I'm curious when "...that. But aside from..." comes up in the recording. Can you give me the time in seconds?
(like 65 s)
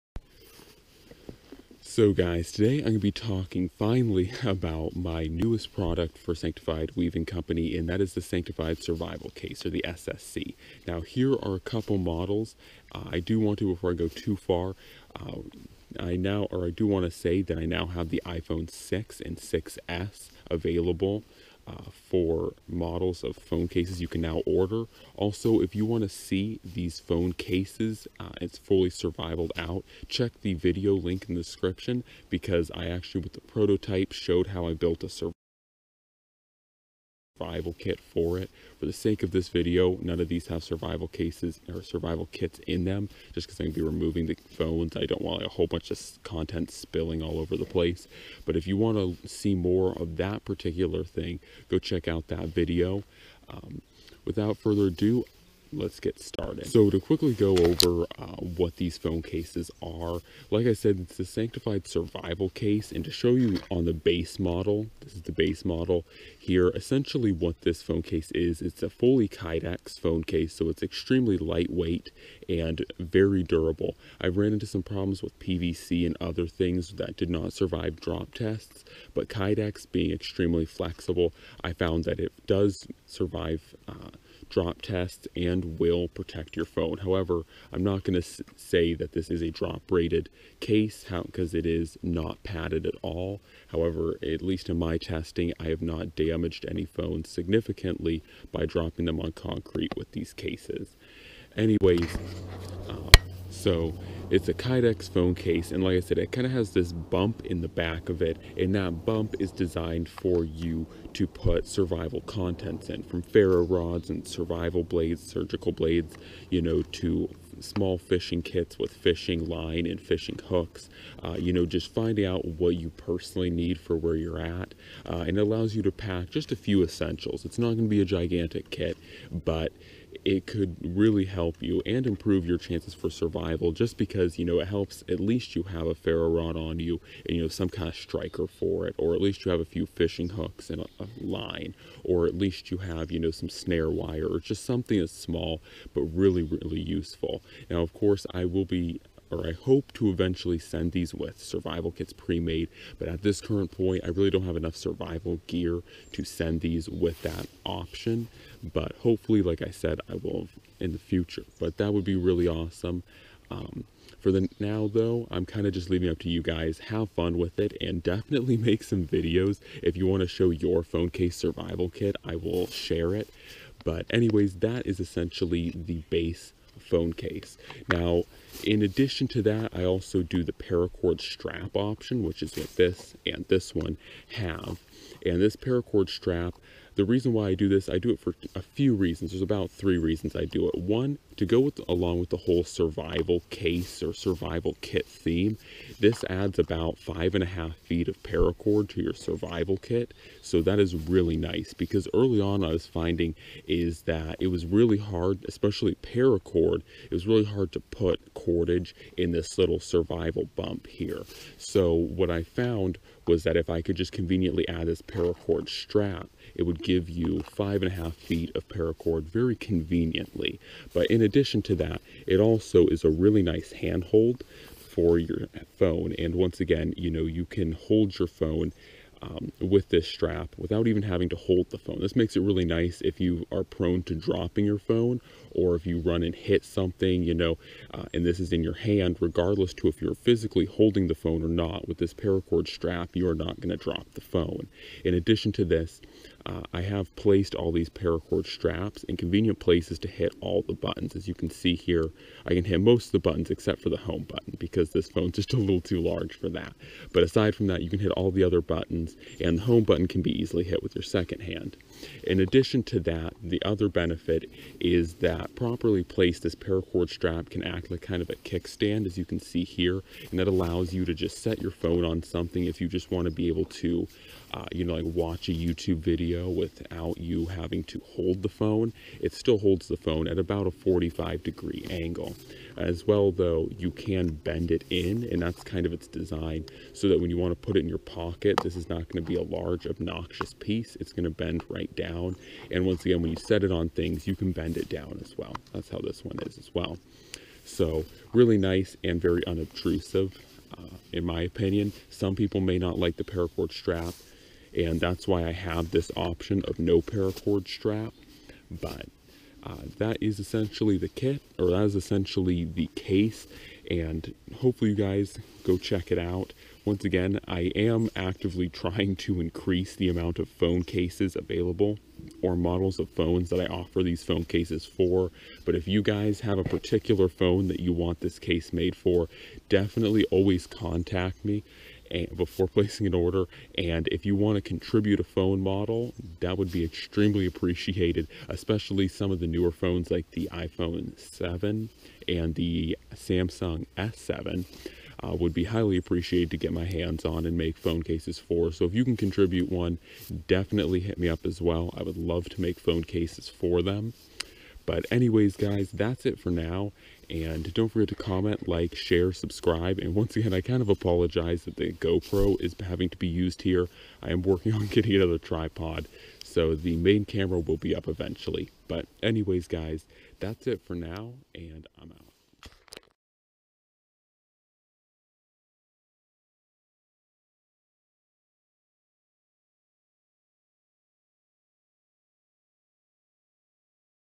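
256 s.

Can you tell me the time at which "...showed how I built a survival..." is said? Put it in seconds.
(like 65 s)
34 s.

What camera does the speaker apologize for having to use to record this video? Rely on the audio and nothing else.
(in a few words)
GoPro.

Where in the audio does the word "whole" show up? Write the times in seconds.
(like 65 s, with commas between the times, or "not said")
45 s, 192 s.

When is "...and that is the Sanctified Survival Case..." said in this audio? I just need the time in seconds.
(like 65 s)
7 s.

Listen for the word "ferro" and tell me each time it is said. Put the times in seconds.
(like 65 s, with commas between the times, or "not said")
113 s, 135 s.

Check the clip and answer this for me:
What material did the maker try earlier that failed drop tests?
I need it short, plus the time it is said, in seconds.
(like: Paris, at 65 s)
PVC, at 75 s.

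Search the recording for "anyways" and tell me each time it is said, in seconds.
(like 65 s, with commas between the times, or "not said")
101 s, 174 s, 355 s, 369 s.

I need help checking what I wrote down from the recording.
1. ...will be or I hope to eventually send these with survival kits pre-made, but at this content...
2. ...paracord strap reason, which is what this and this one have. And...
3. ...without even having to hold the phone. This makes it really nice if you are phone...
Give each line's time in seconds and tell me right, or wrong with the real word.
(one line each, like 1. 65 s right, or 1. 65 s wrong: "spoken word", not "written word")
1. 148 s wrong: "current", not "content"
2. 180 s wrong: "option", not "reason"
3. 230 s wrong: "prone", not "phone".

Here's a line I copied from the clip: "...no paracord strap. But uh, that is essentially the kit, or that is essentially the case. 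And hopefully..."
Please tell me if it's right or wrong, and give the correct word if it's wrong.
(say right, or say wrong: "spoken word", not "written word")
right.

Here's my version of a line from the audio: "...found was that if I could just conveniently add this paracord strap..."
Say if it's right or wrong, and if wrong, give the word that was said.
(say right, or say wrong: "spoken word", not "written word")
right.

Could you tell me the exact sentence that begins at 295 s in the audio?
That's how this one is as well.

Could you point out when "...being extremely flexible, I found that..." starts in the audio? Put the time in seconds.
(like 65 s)
79 s.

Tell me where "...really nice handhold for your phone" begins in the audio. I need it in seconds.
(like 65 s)
223 s.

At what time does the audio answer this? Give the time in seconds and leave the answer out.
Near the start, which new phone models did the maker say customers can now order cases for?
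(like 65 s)
18 s.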